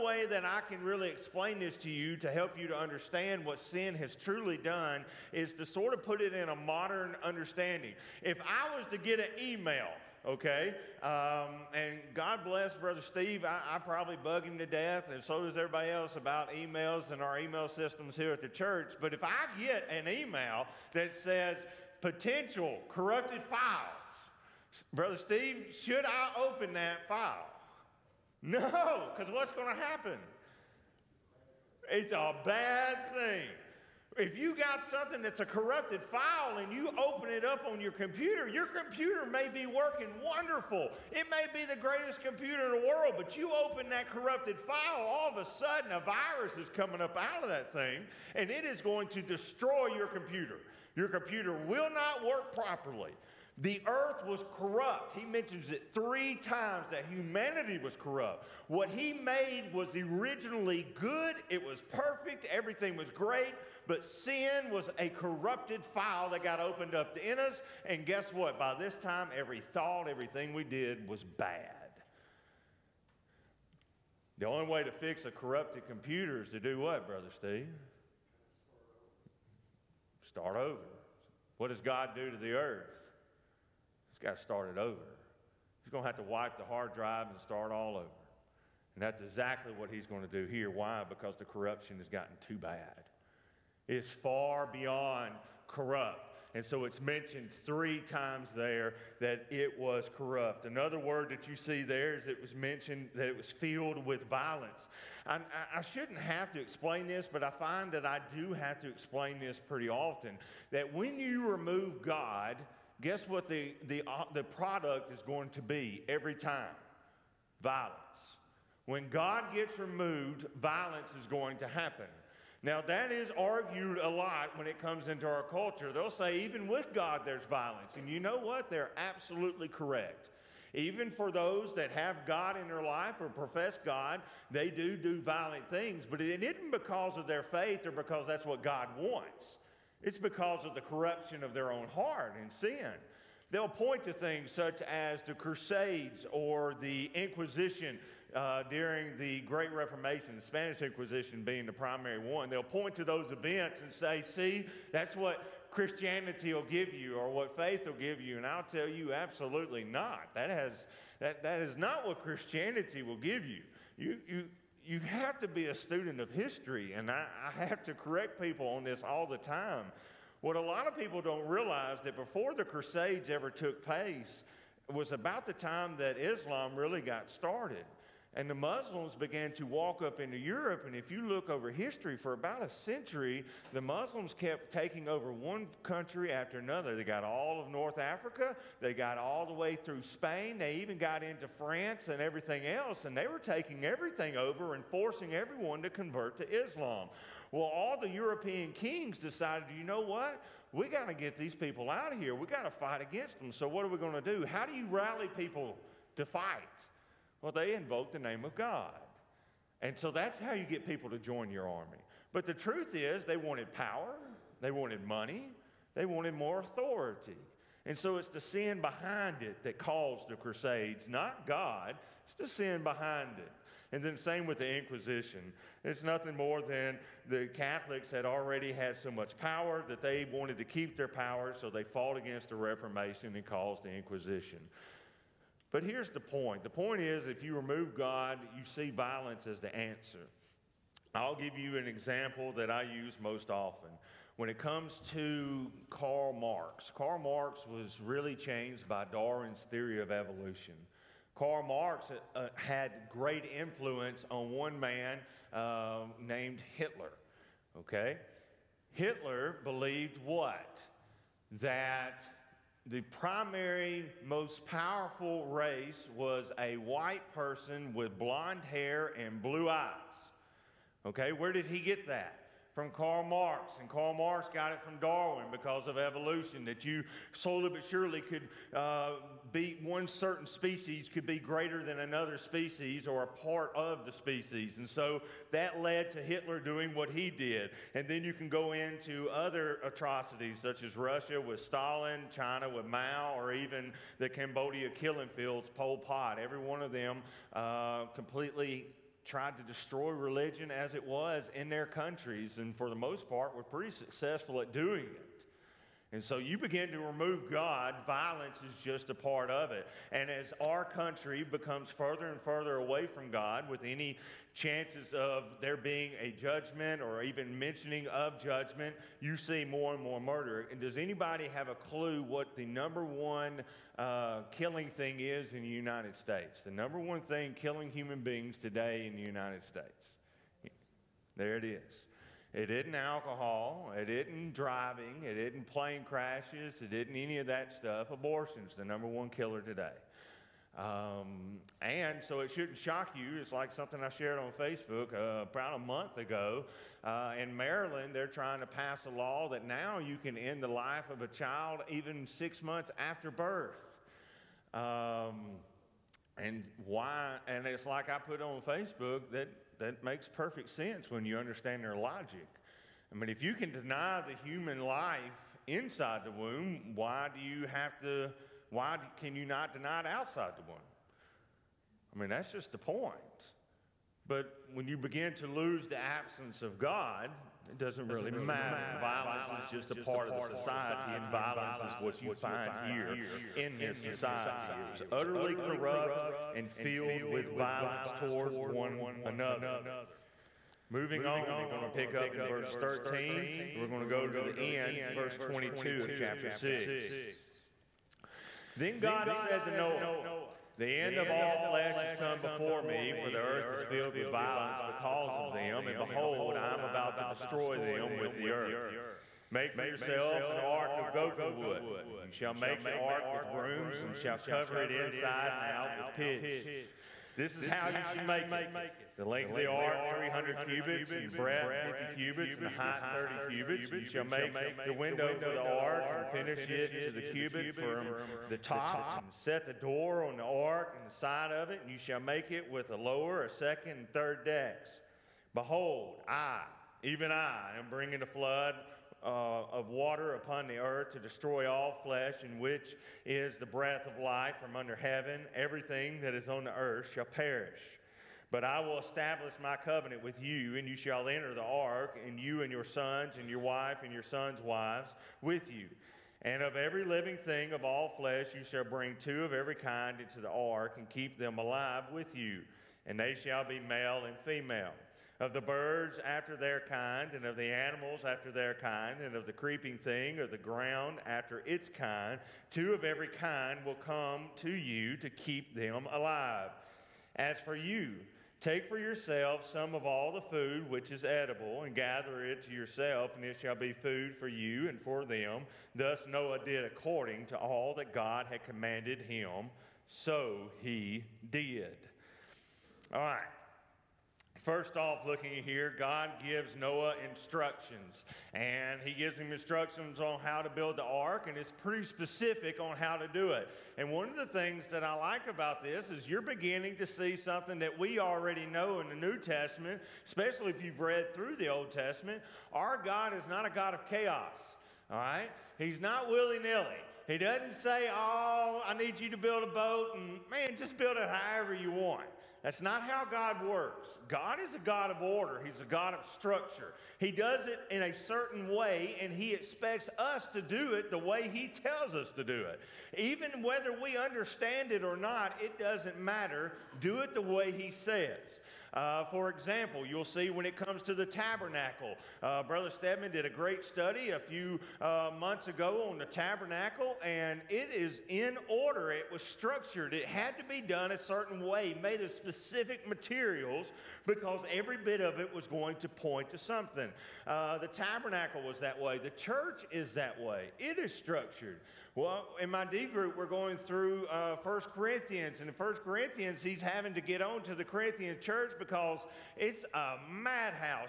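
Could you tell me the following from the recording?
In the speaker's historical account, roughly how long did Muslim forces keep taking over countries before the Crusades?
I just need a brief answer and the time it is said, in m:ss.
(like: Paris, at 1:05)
a century, at 3:02.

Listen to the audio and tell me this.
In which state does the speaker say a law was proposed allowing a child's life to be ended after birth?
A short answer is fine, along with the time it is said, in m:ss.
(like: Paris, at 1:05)
Maryland, at 5:47.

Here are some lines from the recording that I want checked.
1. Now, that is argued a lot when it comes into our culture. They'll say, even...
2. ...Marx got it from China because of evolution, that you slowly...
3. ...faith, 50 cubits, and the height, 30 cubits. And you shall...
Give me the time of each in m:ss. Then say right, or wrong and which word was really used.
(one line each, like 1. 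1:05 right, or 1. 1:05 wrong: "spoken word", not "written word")
1. 2:02 right
2. 4:34 wrong: "Darwin", not "China"
3. 7:01 wrong: "breadth", not "faith".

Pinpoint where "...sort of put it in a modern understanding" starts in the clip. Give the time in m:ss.
0:05.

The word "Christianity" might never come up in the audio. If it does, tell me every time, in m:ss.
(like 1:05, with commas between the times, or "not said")
2:35, 2:42.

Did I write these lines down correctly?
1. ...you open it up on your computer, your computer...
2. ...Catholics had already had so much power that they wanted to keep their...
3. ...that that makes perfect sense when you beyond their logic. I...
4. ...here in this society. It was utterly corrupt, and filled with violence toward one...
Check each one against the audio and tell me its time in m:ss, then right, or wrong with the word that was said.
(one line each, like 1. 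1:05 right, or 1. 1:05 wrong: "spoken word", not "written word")
1. 0:36 right
2. 3:47 right
3. 5:59 wrong: "understand", not "beyond"
4. 6:22 right.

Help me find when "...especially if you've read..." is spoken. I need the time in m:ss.
8:30.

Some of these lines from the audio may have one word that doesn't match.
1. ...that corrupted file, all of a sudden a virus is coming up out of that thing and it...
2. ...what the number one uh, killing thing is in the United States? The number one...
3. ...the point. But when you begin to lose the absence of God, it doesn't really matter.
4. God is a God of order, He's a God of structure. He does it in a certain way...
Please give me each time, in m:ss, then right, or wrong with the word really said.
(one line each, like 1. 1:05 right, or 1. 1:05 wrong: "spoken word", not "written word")
1. 0:43 right
2. 5:22 right
3. 6:12 right
4. 8:44 right.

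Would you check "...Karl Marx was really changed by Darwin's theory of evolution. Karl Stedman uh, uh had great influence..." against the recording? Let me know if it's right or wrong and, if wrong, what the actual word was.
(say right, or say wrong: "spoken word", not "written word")
wrong: "Marx", not "Stedman".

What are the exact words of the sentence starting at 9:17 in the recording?
Uh, the tabernacle was that way, the church is that way, it is structured.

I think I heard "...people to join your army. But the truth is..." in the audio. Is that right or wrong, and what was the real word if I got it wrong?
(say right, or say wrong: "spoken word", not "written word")
right.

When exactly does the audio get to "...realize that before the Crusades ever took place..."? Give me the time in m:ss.
2:51.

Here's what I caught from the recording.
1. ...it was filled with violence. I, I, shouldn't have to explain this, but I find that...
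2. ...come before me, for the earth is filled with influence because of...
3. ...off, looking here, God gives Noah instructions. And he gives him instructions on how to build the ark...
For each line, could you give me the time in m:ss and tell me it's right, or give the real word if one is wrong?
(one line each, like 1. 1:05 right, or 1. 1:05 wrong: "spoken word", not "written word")
1. 1:43 right
2. 6:42 wrong: "violence", not "influence"
3. 8:14 right.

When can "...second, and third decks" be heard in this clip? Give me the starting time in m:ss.
7:13.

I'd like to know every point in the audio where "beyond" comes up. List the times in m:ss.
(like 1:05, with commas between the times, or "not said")
1:34.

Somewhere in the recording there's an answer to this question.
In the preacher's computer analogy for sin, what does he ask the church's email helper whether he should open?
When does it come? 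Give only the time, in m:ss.
0:21.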